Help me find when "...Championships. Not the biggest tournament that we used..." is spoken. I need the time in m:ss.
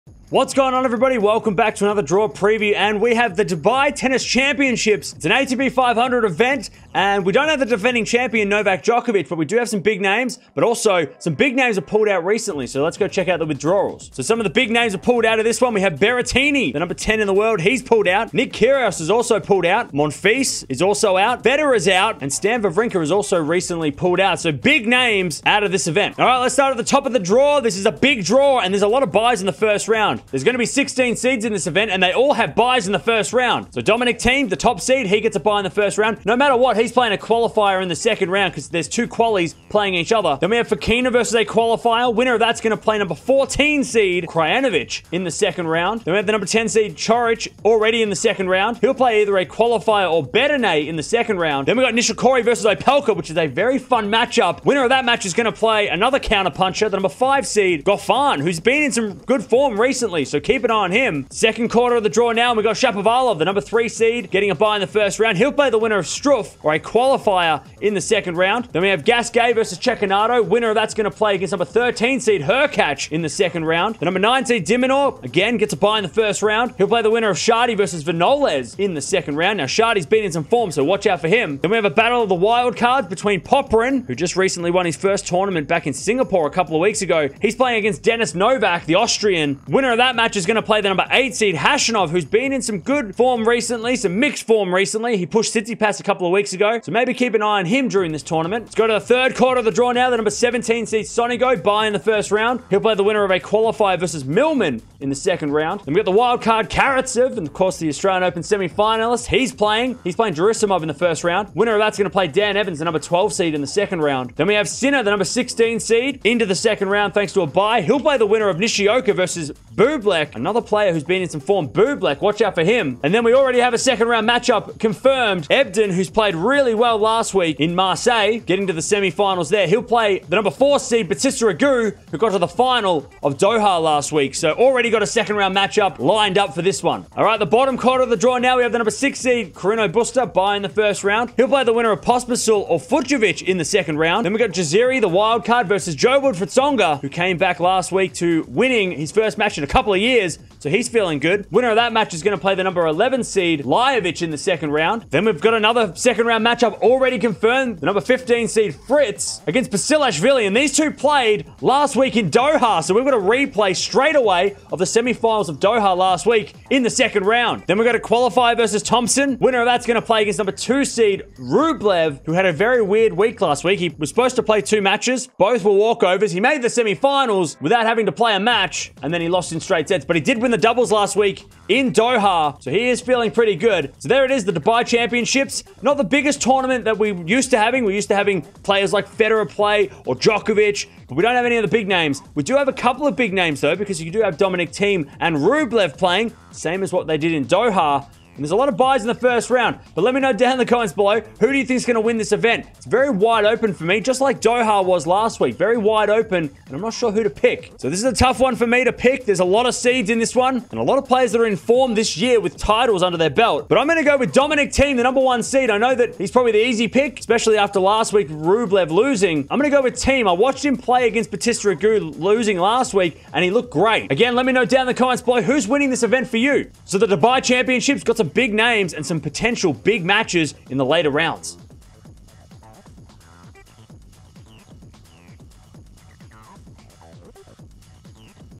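3:04.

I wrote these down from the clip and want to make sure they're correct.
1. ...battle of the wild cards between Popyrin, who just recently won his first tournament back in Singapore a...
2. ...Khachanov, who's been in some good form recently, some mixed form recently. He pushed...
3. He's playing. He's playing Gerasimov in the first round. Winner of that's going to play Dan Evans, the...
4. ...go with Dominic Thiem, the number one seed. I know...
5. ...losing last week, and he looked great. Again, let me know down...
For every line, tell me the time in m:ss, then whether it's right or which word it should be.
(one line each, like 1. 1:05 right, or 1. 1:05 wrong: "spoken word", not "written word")
1. 1:21 right
2. 1:31 right
3. 1:49 right
4. 3:34 right
5. 3:42 right.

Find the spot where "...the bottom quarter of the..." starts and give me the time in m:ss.
2:17.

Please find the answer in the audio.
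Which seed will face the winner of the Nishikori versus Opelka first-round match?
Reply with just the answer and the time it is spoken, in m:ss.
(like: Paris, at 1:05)
Goffin, at 0:57.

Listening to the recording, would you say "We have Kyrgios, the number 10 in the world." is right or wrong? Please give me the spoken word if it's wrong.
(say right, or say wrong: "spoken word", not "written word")
wrong: "Berrettini", not "Kyrgios".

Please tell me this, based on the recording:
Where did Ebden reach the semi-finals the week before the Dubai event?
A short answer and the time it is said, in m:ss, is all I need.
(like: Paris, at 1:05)
Marseille, at 2:07.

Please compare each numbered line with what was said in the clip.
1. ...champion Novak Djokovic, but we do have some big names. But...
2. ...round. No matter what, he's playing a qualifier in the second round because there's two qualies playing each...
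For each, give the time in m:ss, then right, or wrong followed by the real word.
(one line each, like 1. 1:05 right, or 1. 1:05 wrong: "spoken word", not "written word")
1. 0:08 right
2. 0:35 right.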